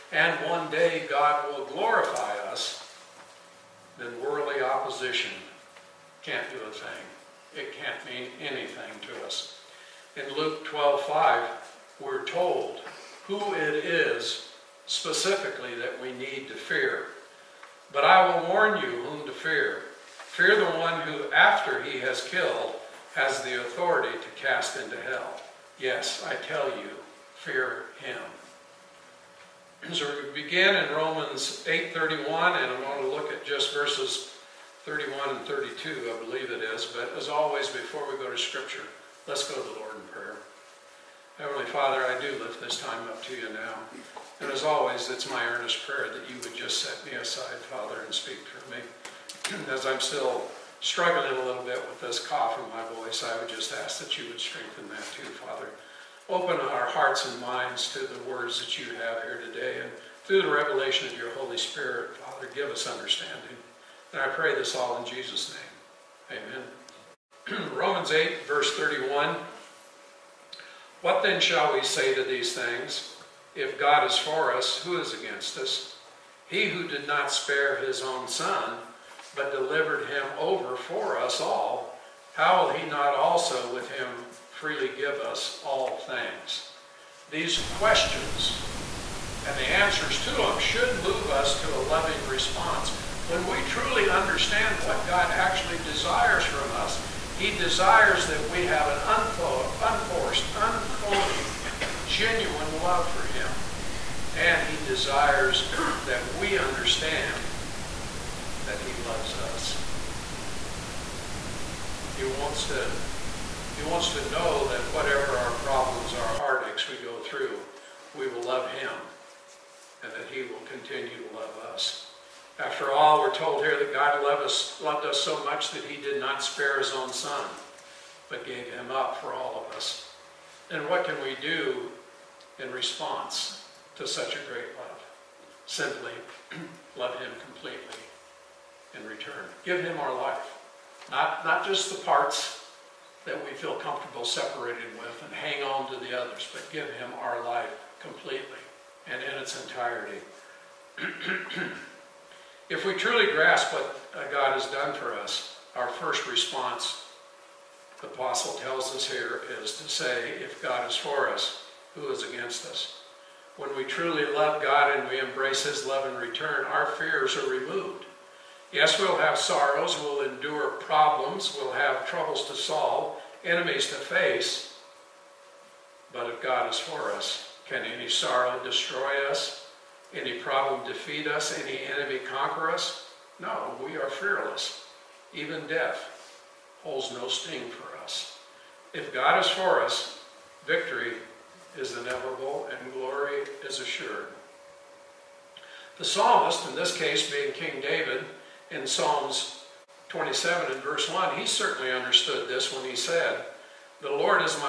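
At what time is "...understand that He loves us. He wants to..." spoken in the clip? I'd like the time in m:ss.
1:46.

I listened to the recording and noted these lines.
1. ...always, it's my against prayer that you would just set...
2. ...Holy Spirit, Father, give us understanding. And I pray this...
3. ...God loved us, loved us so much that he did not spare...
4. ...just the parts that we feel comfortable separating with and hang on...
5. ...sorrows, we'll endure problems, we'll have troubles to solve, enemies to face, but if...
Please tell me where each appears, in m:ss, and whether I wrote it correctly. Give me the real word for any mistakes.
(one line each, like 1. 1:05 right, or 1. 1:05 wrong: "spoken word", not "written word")
1. 0:44 wrong: "earnest", not "against"
2. 1:01 right
3. 2:03 right
4. 2:21 right
5. 2:49 right.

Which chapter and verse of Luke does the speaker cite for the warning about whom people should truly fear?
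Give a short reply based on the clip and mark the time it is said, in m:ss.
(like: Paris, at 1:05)
Luke 12:5, at 0:10.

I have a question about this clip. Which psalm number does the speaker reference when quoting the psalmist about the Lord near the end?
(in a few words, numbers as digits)
27.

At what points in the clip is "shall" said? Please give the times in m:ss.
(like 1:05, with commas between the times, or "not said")
1:11.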